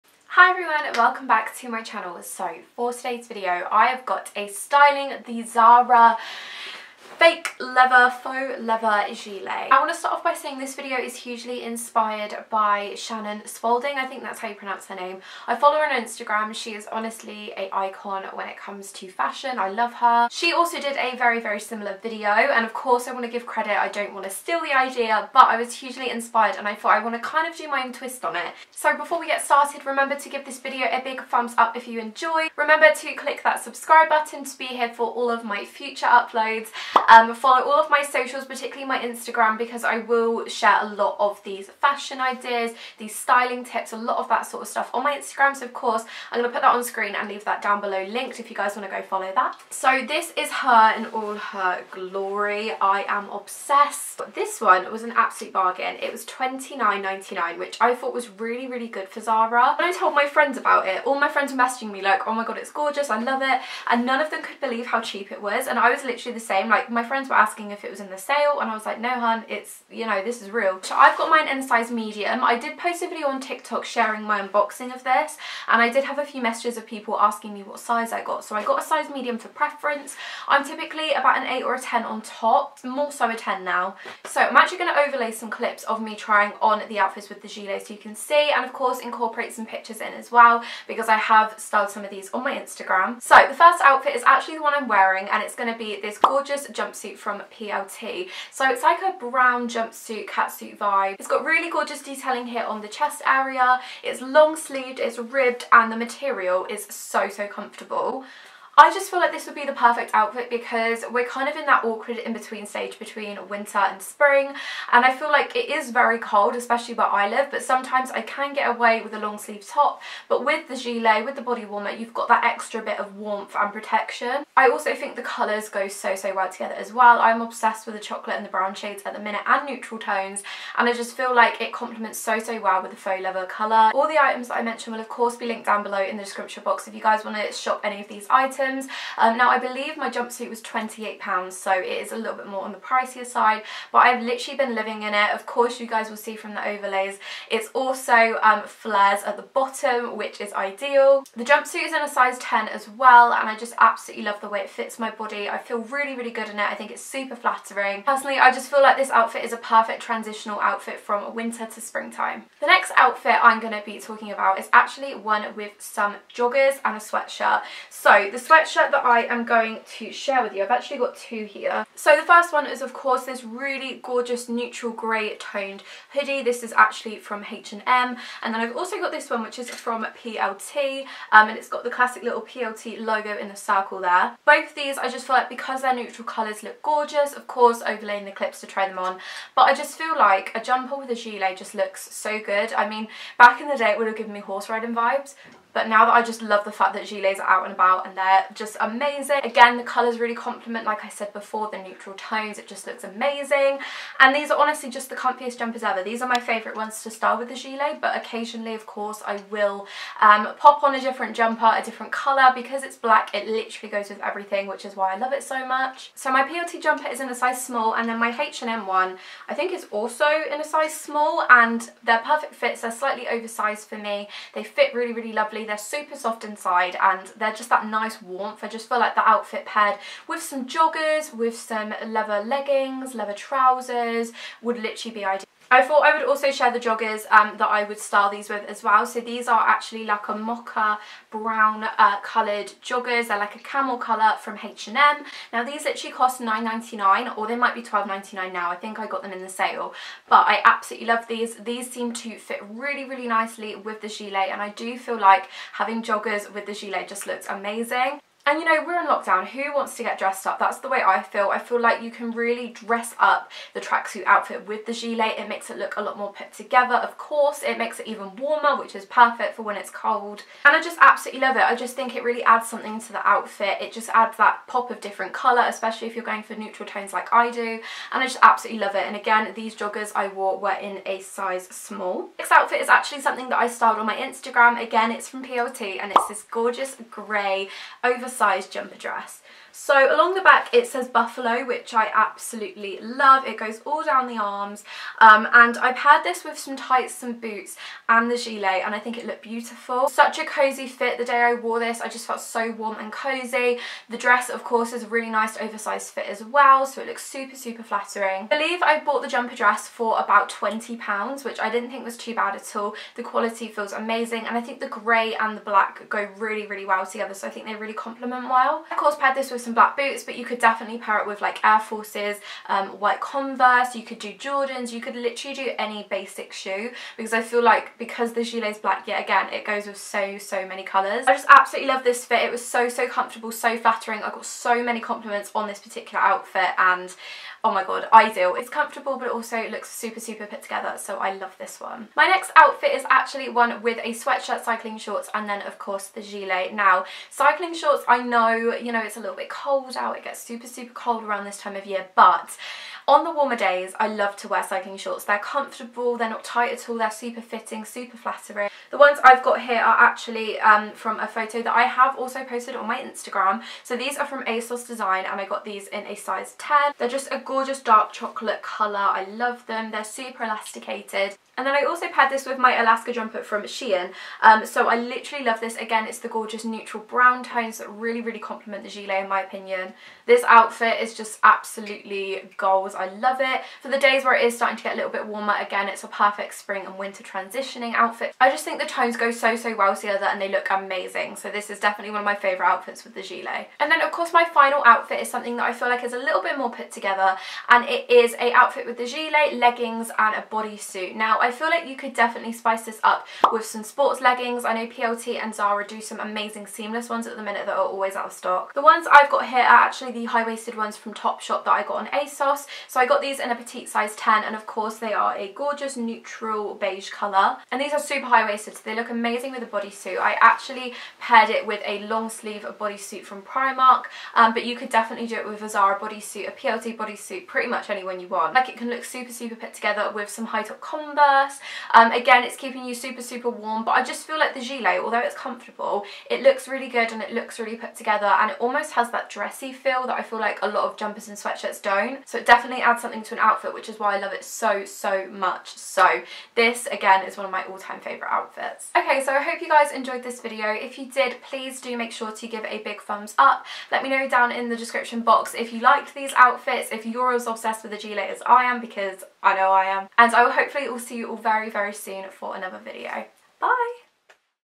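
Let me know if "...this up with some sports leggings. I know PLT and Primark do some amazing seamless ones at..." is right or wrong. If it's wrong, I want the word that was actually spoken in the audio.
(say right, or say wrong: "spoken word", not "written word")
wrong: "Zara", not "Primark".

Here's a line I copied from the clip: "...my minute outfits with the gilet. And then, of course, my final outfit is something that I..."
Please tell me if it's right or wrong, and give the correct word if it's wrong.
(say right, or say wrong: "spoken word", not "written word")
wrong: "favourite", not "minute".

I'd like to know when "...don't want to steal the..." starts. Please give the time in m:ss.
0:23.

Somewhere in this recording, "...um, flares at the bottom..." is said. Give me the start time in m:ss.
2:28.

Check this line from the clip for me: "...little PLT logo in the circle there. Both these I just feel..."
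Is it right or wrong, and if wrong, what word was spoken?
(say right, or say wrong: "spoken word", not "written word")
right.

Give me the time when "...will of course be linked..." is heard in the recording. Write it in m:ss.
2:14.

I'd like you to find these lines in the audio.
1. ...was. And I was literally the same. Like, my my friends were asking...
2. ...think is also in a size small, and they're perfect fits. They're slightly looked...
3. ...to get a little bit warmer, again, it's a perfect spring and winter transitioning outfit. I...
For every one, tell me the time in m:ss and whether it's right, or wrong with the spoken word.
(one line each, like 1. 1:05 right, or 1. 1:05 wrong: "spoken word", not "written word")
1. 1:05 right
2. 3:39 wrong: "oversized", not "looked"
3. 6:24 right.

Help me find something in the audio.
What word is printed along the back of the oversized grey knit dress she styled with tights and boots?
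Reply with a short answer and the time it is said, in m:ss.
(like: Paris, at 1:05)
Buffalo, at 4:51.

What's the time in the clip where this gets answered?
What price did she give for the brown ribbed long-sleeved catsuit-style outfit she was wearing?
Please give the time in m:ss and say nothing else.
2:20.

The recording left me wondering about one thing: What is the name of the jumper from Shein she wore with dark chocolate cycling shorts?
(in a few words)
Alaska.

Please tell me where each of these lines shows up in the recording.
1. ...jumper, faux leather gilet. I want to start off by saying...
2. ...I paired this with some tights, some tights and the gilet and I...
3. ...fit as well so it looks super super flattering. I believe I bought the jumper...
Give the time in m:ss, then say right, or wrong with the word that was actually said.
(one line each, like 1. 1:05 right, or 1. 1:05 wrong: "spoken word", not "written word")
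1. 0:07 wrong: "leather", not "jumper"
2. 4:55 wrong: "boots", not "tights"
3. 5:06 right.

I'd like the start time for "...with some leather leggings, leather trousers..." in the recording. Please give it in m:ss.
3:51.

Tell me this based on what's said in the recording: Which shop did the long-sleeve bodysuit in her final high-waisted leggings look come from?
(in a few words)
Primark.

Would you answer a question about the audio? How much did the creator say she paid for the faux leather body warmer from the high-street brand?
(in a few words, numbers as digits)
£29.99.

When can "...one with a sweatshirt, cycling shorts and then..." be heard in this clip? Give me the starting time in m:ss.
5:43.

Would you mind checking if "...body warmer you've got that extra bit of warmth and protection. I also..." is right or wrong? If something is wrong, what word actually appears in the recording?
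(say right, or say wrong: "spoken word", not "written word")
right.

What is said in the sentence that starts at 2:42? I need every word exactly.
The next outfit I'm going to be talking about is actually one with some joggers and a sweatshirt.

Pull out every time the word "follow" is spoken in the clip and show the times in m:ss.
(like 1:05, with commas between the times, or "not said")
0:15, 0:37, 0:49.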